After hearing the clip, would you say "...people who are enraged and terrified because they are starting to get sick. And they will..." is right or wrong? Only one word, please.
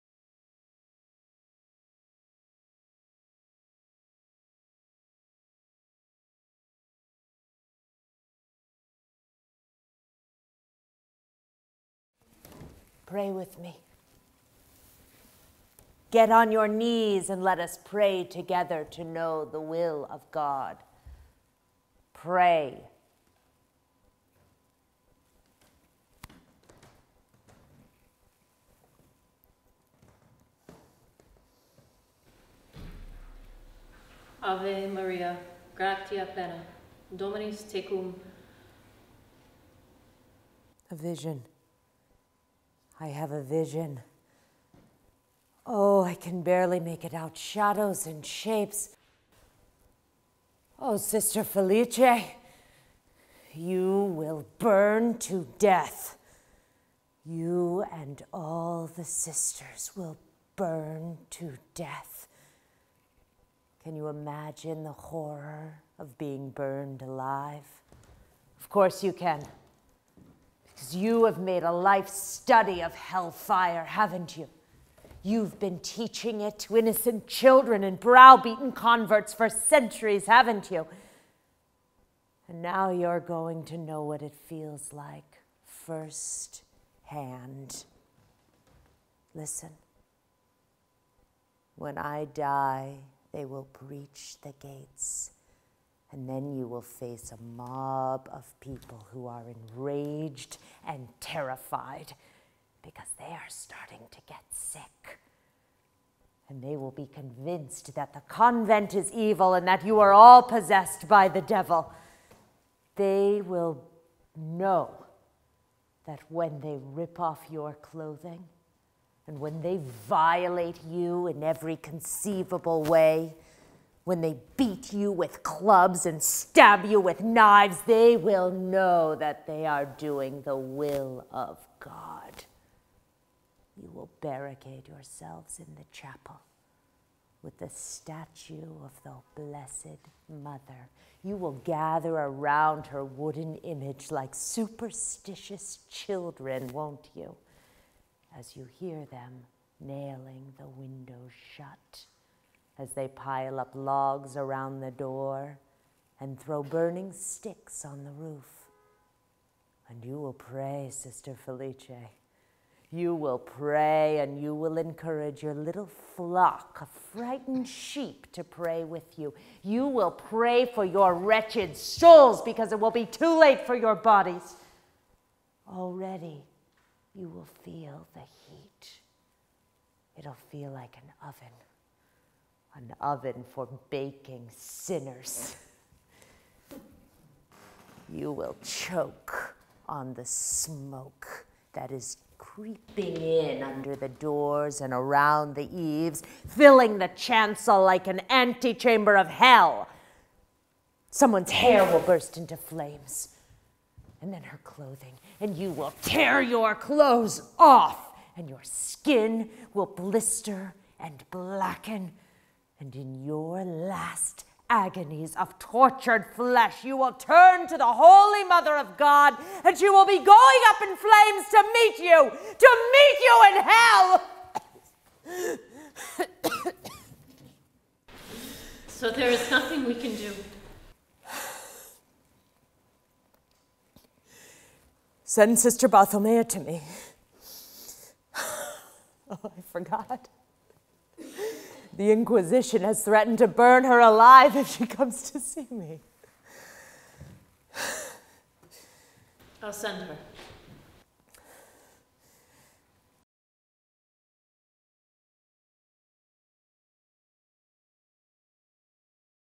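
right.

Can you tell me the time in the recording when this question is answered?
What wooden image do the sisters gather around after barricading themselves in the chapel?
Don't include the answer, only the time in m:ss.
2:17.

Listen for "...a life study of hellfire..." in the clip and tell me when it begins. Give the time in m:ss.
1:11.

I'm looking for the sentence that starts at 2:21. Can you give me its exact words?
You will gather around her wooden image like superstitious children, won't you?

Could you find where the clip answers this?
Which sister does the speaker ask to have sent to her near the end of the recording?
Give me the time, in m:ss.
3:55.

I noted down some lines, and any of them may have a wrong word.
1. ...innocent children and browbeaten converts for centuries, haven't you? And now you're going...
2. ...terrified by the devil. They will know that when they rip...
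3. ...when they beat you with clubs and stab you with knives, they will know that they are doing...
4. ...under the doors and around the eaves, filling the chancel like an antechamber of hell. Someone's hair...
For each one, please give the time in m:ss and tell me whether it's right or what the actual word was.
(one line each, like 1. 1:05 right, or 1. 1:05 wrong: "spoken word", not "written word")
1. 1:16 right
2. 1:50 wrong: "possessed", not "terrified"
3. 2:04 right
4. 3:13 right.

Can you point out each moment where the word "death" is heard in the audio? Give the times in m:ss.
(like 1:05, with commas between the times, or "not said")
0:55, 1:01.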